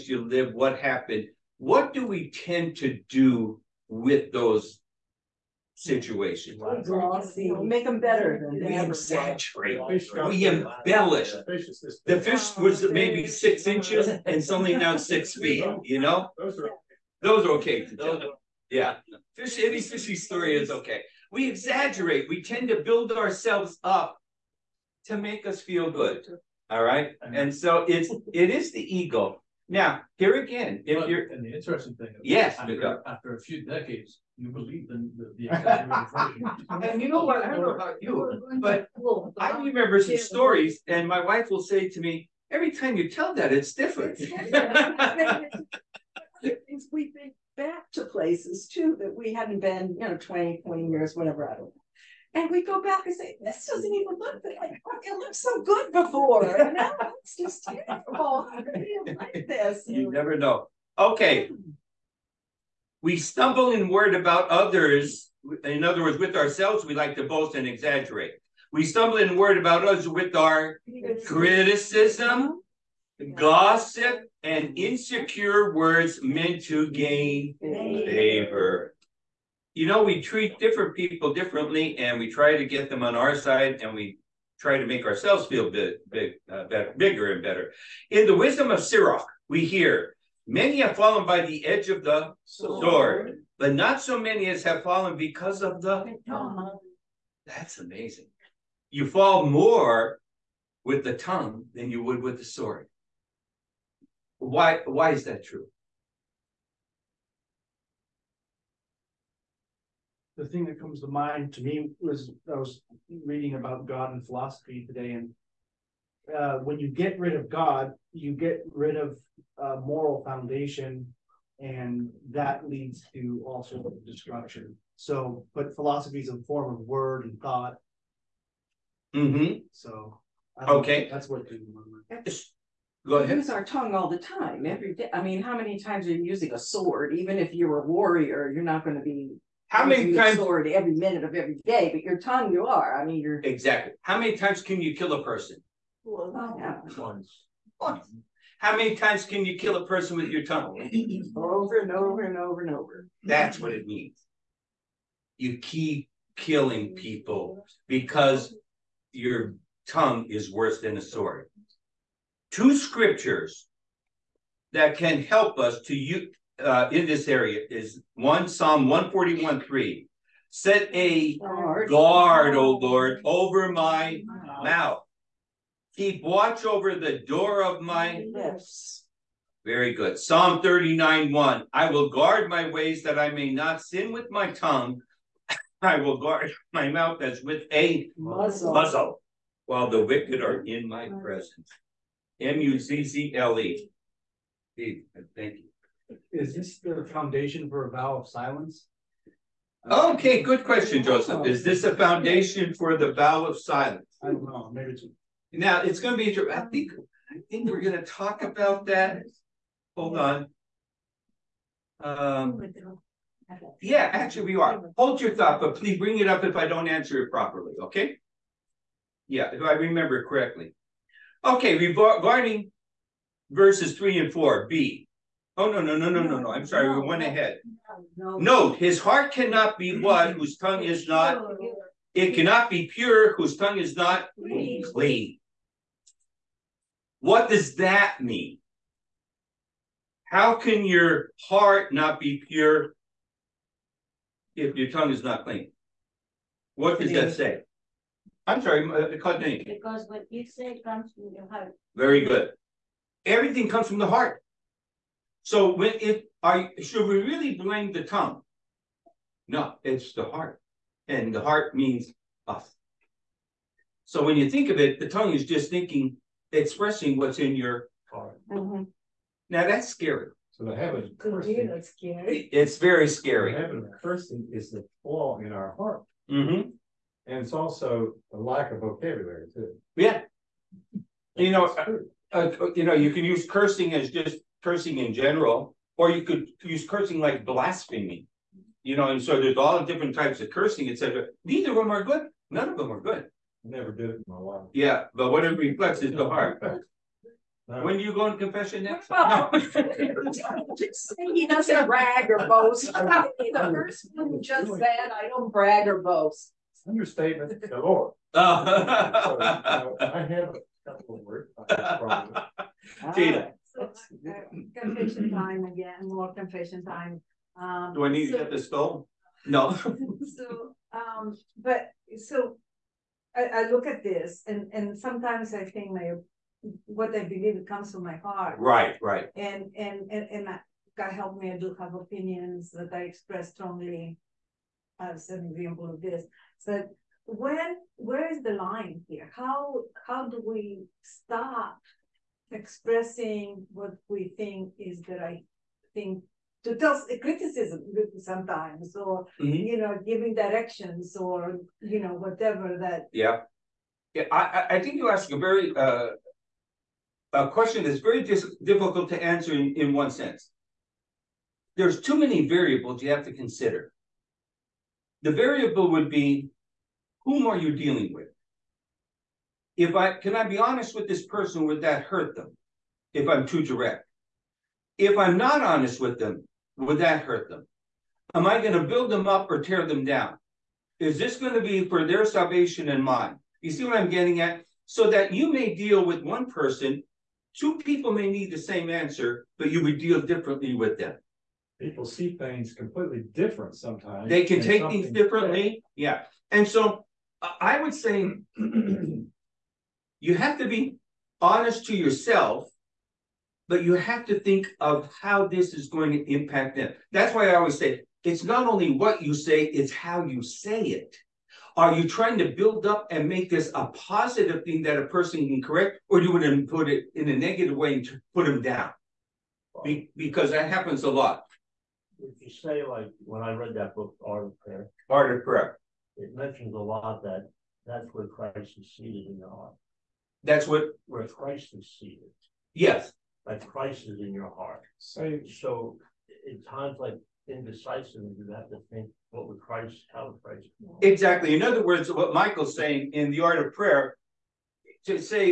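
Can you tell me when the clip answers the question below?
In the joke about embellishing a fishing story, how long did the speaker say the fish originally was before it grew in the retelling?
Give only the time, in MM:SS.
00:13.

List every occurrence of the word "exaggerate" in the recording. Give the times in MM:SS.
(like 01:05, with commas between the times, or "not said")
00:08, 00:21, 01:07.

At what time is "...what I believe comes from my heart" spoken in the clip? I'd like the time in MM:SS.
05:26.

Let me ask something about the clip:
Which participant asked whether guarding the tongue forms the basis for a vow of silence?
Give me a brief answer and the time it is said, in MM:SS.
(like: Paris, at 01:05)
Joseph, at 03:21.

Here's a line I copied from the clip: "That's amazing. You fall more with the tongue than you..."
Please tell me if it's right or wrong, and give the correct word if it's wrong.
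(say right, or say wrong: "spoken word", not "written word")
right.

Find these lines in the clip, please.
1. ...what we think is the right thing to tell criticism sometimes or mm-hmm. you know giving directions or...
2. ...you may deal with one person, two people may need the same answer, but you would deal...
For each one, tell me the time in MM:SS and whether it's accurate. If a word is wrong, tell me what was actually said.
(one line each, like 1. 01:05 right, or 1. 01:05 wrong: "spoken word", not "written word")
1. 05:43 right
2. 06:25 right.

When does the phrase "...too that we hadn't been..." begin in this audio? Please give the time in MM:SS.
00:48.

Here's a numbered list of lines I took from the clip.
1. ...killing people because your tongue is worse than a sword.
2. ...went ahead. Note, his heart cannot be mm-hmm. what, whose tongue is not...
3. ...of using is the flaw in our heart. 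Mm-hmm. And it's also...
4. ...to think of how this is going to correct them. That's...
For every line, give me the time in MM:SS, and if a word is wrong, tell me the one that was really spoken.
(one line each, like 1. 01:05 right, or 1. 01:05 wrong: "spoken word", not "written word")
1. 02:36 right
2. 03:47 right
3. 04:33 wrong: "cursing", not "using"
4. 06:44 wrong: "impact", not "correct".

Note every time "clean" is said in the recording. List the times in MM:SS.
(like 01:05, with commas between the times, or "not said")
03:54, 04:05.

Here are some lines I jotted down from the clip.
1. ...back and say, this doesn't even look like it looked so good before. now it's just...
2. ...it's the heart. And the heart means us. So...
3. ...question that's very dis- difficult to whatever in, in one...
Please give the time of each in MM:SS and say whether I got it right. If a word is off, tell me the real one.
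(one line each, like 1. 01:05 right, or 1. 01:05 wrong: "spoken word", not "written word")
1. 00:52 right
2. 04:19 right
3. 05:57 wrong: "answer", not "whatever".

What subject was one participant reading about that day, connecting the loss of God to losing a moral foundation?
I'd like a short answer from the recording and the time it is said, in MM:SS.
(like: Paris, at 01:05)
God and philosophy, at 01:53.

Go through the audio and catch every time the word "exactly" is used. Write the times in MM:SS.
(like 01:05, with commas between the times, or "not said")
02:23, 07:21.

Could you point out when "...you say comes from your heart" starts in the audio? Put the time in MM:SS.
04:10.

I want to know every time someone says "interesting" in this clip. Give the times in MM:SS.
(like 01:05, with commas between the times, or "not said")
00:31.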